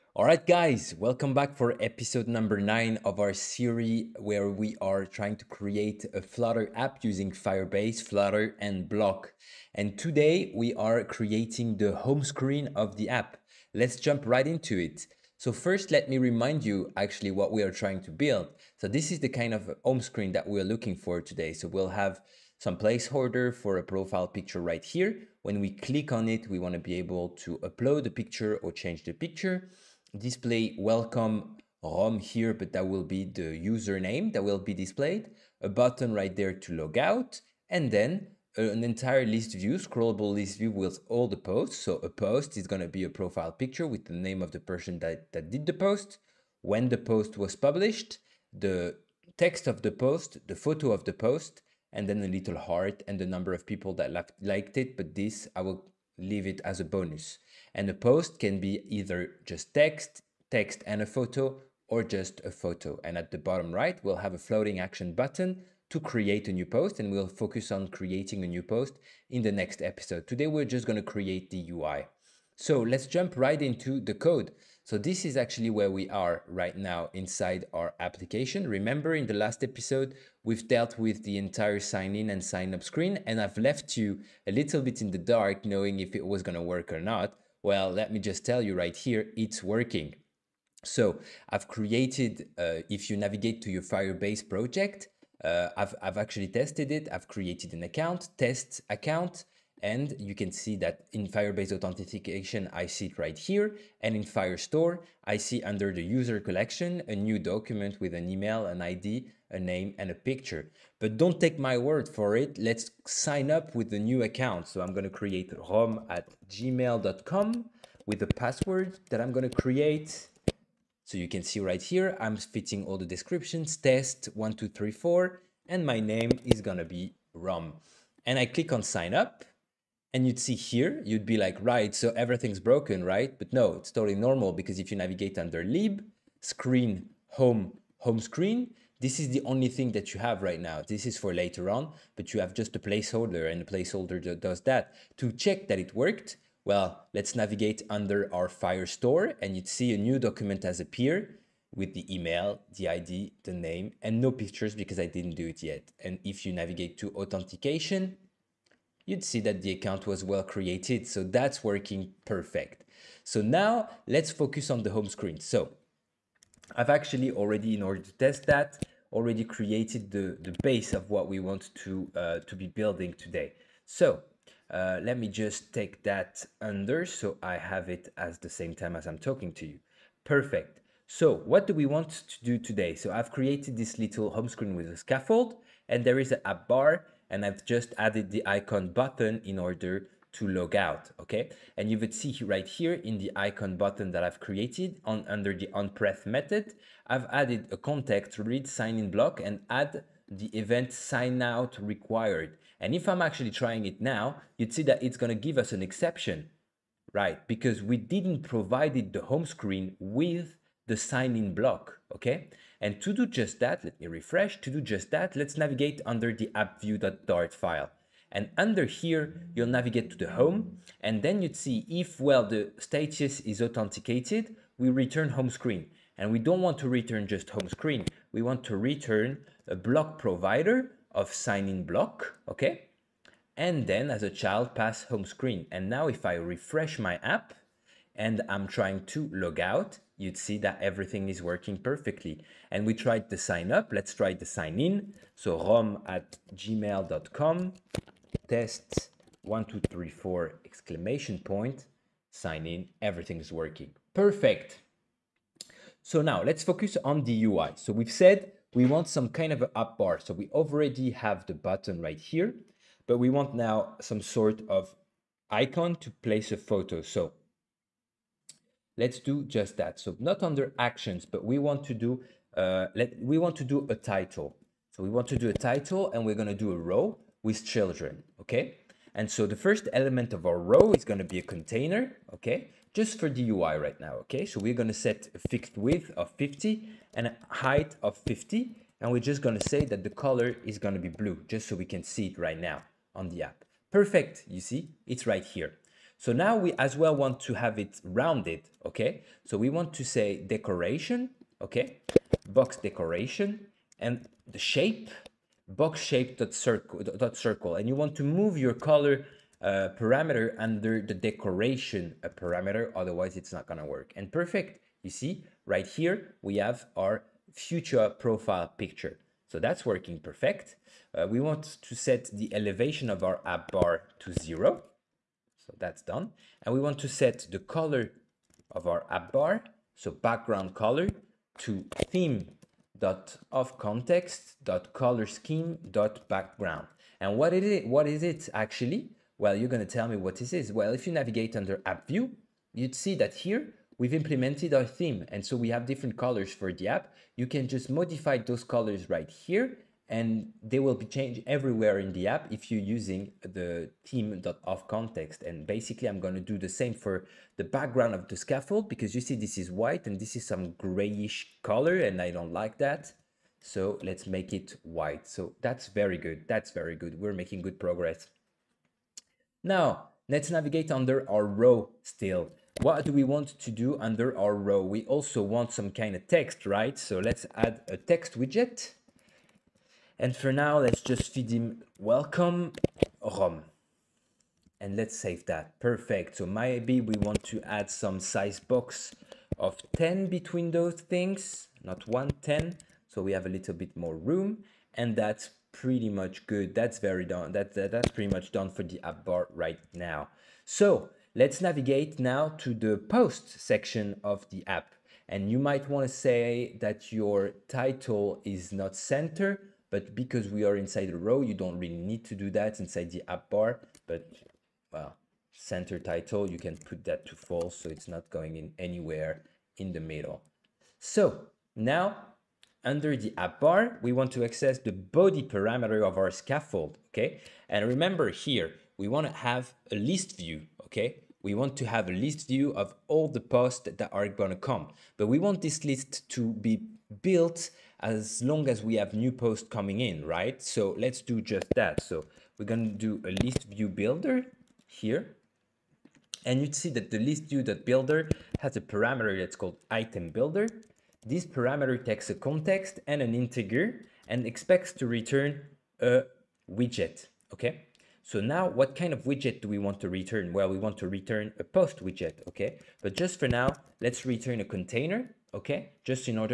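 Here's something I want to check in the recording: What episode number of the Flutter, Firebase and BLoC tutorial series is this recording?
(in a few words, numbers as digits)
9.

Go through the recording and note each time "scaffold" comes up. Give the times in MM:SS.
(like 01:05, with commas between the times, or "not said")
03:04, 05:58, 07:06.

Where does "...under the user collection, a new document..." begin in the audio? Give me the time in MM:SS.
01:45.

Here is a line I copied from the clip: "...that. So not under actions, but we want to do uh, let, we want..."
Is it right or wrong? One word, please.
right.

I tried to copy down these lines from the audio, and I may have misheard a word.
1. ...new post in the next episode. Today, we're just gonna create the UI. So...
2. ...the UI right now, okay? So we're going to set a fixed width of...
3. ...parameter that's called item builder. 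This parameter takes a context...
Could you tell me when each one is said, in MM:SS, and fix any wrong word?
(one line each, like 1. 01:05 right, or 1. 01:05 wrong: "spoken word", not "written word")
1. 01:08 right
2. 04:43 right
3. 07:28 right.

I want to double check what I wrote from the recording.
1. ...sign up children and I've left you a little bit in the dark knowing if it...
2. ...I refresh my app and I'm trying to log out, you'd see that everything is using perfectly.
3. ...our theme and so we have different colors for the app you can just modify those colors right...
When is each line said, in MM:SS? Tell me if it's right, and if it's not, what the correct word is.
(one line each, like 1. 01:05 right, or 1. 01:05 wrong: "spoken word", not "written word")
1. 01:22 wrong: "screen", not "children"
2. 03:56 wrong: "working", not "using"
3. 05:44 right.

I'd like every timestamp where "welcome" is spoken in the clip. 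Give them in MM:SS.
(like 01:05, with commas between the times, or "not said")
00:00, 00:30, 06:21.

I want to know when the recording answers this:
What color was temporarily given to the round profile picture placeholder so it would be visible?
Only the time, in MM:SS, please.
04:51.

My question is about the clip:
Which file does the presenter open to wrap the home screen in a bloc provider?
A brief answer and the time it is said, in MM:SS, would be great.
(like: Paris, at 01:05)
appview.dart, at 03:36.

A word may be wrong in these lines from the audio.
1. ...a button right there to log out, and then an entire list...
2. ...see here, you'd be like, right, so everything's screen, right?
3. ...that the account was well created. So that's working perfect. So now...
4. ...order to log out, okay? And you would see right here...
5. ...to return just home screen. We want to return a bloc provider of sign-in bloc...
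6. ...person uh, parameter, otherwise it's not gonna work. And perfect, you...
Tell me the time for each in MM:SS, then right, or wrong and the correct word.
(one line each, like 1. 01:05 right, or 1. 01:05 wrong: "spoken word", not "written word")
1. 00:35 right
2. 02:10 wrong: "broken", not "screen"
3. 02:39 right
4. 03:09 right
5. 03:46 right
6. 05:11 wrong: "decoration", not "person".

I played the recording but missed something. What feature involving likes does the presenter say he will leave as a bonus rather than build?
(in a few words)
a little heart.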